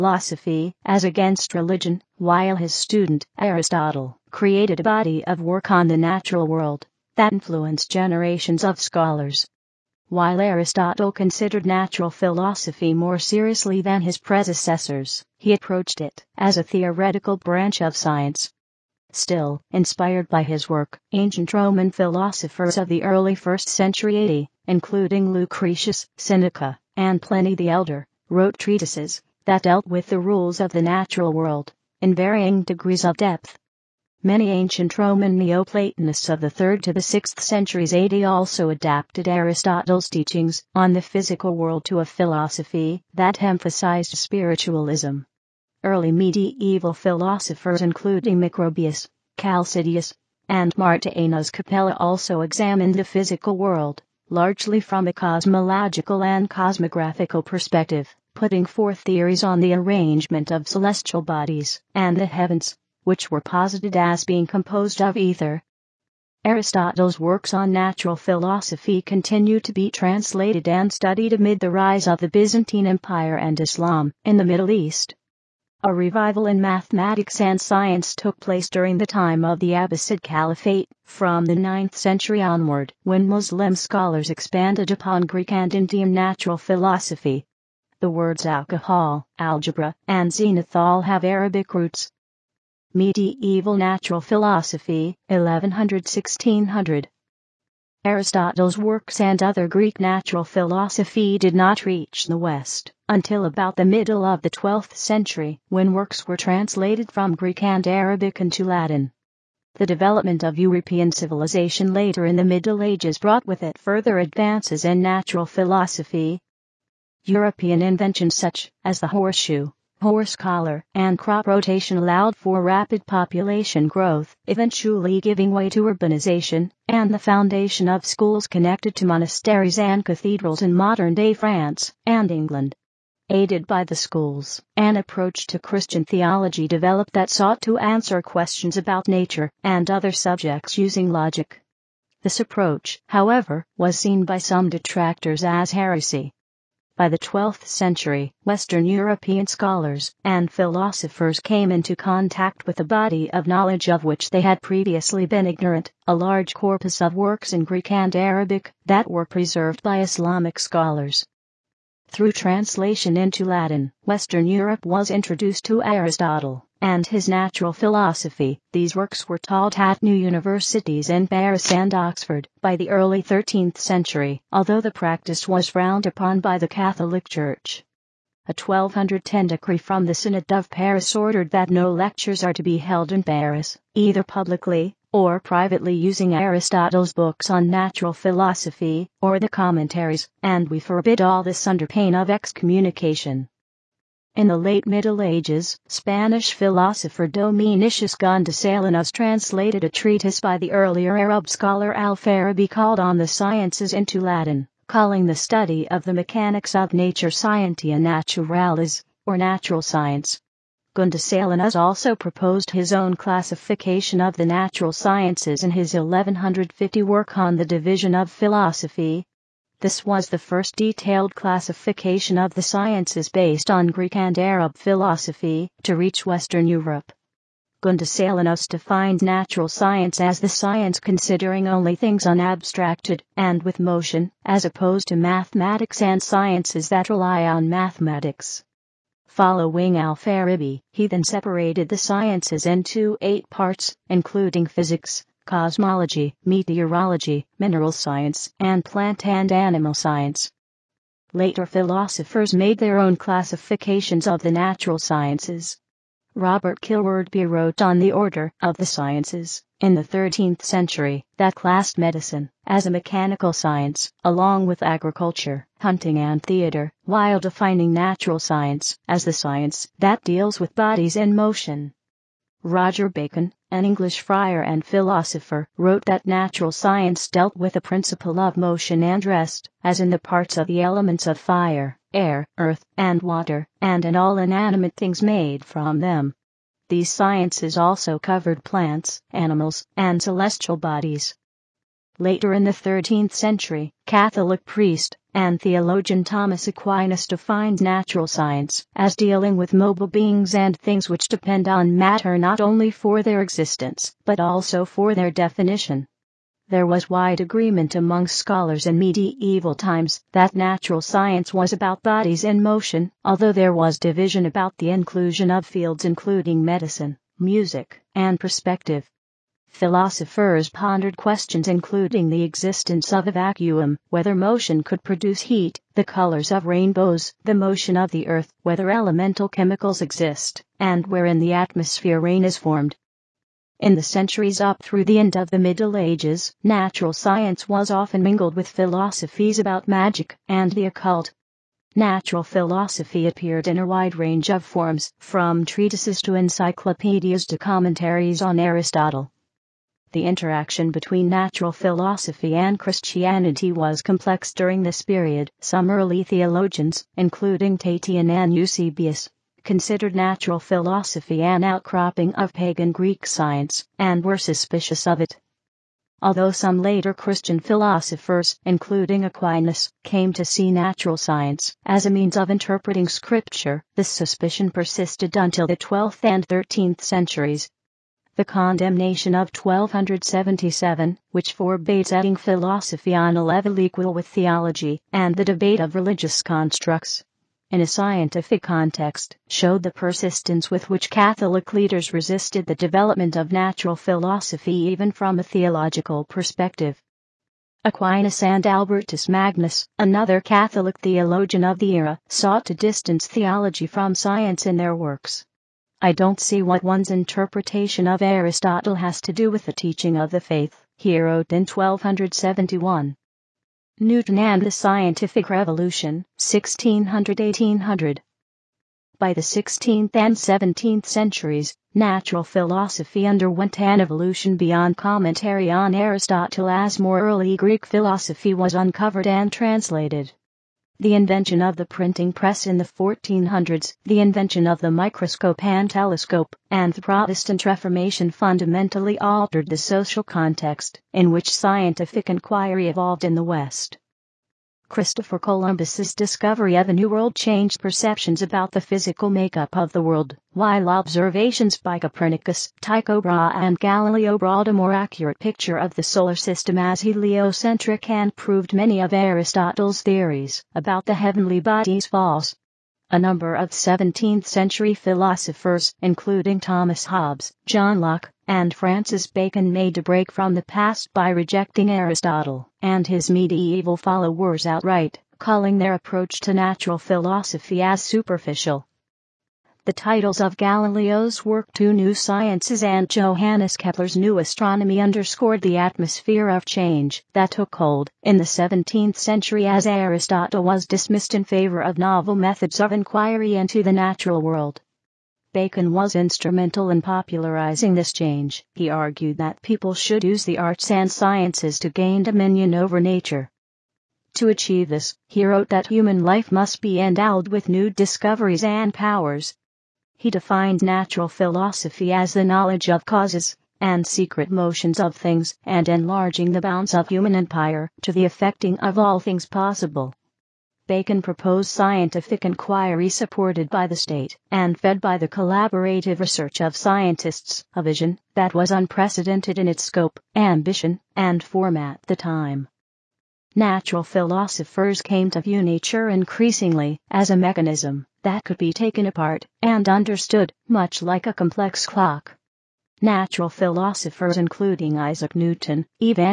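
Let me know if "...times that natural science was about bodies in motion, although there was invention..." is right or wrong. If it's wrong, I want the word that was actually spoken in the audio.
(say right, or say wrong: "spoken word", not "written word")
wrong: "division", not "invention".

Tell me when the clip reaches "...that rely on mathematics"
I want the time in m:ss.
3:56.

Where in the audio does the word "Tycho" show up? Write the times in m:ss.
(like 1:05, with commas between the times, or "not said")
7:32.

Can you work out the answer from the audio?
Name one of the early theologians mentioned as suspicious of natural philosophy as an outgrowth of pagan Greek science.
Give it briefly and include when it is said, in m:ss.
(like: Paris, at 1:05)
Tatian, at 5:57.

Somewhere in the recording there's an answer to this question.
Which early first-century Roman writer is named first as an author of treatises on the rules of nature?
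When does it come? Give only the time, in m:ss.
0:25.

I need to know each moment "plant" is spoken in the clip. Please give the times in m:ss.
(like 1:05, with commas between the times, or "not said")
4:08, 4:48.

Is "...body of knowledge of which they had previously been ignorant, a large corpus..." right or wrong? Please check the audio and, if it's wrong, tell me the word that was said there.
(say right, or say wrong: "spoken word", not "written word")
right.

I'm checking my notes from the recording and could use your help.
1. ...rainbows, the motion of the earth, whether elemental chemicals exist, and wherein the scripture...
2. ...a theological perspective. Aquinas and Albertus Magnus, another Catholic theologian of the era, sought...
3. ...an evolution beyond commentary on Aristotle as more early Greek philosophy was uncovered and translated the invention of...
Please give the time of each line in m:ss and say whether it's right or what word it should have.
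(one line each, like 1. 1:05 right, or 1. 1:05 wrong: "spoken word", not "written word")
1. 5:26 wrong: "atmosphere", not "scripture"
2. 6:35 right
3. 7:03 right.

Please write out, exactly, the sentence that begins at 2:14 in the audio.
An approach to Christian theology developed that sought to answer questions about nature and other subjects using logic.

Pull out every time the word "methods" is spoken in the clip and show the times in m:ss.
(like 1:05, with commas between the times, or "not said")
8:12.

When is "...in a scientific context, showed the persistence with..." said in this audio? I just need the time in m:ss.
6:27.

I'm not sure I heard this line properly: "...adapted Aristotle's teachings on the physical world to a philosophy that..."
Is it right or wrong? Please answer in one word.
right.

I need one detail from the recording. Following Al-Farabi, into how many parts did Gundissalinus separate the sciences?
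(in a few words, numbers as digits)
8.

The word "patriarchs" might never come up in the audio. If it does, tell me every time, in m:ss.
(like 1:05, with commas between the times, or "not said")
not said.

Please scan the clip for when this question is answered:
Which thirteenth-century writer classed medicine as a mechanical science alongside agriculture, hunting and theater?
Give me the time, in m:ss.
4:16.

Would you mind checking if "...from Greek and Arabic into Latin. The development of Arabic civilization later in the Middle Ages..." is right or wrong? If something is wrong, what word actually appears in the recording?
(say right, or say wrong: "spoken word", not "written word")
wrong: "European", not "Arabic".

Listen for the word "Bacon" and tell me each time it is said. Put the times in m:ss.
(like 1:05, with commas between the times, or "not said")
4:33, 7:49, 8:15, 8:40.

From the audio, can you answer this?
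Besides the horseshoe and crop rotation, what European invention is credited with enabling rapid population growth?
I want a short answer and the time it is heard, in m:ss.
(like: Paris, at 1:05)
Horse collar, at 2:00.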